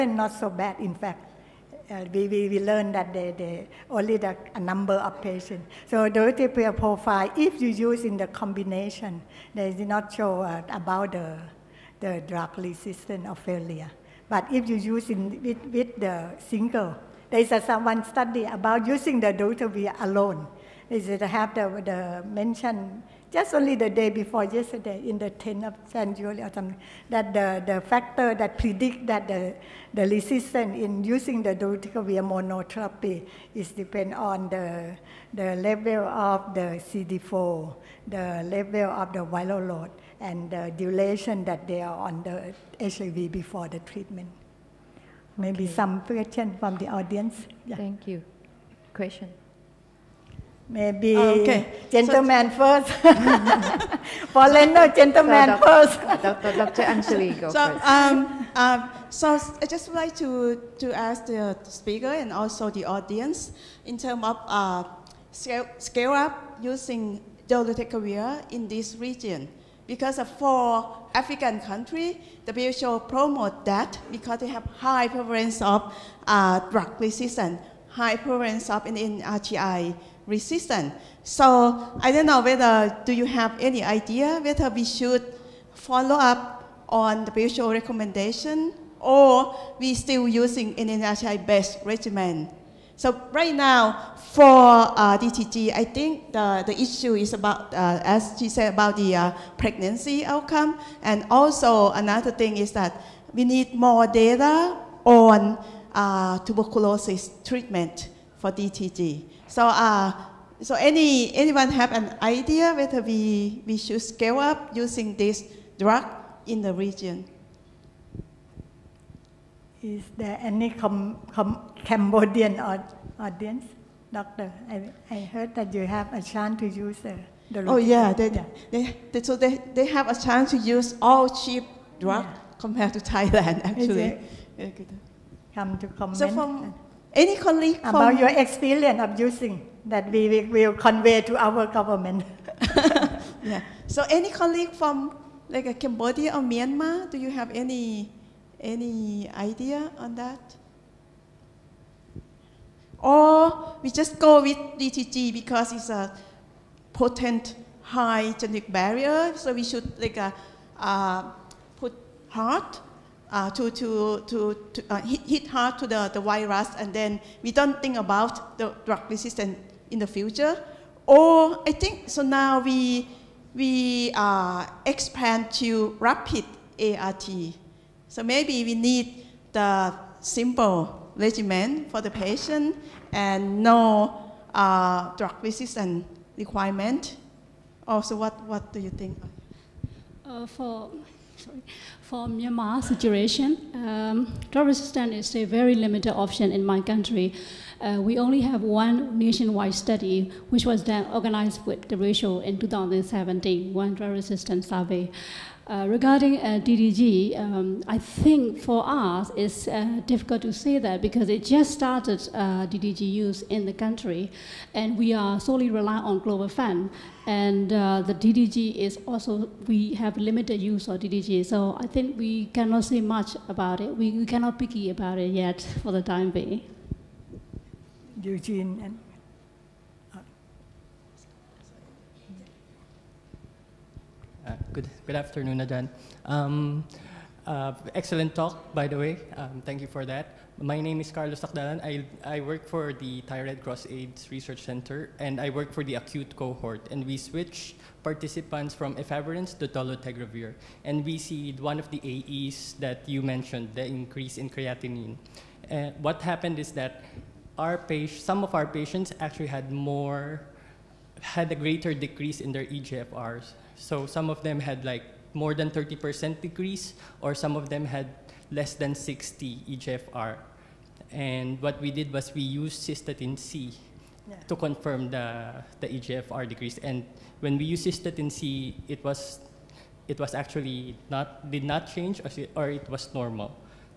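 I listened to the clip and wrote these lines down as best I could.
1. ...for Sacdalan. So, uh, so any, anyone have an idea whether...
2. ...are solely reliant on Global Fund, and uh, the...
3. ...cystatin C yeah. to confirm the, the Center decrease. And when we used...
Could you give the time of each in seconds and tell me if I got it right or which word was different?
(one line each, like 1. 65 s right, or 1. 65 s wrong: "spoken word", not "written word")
1. 108 s wrong: "DTG", not "Sacdalan"
2. 215 s right
3. 272 s wrong: "EGFR", not "Center".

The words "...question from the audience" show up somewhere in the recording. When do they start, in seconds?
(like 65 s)
45 s.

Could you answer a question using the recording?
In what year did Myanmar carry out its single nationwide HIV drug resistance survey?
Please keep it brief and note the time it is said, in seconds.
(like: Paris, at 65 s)
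2017, at 202 s.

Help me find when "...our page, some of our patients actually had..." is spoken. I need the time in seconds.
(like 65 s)
257 s.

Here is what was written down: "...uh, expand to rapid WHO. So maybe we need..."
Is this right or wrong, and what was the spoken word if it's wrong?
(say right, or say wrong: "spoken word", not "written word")
wrong: "ART", not "WHO".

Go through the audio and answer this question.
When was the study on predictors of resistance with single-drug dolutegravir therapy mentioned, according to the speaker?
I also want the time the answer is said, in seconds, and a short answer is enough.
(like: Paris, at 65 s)
10th of January, at 25 s.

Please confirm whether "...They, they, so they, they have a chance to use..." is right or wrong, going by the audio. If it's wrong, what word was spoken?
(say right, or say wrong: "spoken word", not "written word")
right.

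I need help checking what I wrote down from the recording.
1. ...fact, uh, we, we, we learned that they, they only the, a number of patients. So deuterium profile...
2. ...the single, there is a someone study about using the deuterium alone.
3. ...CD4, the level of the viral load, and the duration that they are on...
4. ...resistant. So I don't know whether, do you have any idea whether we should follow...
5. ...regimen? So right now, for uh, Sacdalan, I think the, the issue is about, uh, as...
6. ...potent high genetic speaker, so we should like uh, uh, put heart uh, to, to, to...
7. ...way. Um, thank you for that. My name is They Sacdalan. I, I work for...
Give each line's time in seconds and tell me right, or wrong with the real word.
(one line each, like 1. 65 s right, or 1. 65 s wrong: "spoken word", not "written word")
1. 0 s right
2. 15 s right
3. 36 s right
4. 80 s right
5. 91 s wrong: "DTG", not "Sacdalan"
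6. 156 s wrong: "barrier", not "speaker"
7. 238 s wrong: "Carlos", not "They".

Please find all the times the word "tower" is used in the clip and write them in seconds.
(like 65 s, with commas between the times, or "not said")
not said.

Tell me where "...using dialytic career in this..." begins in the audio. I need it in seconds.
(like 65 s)
66 s.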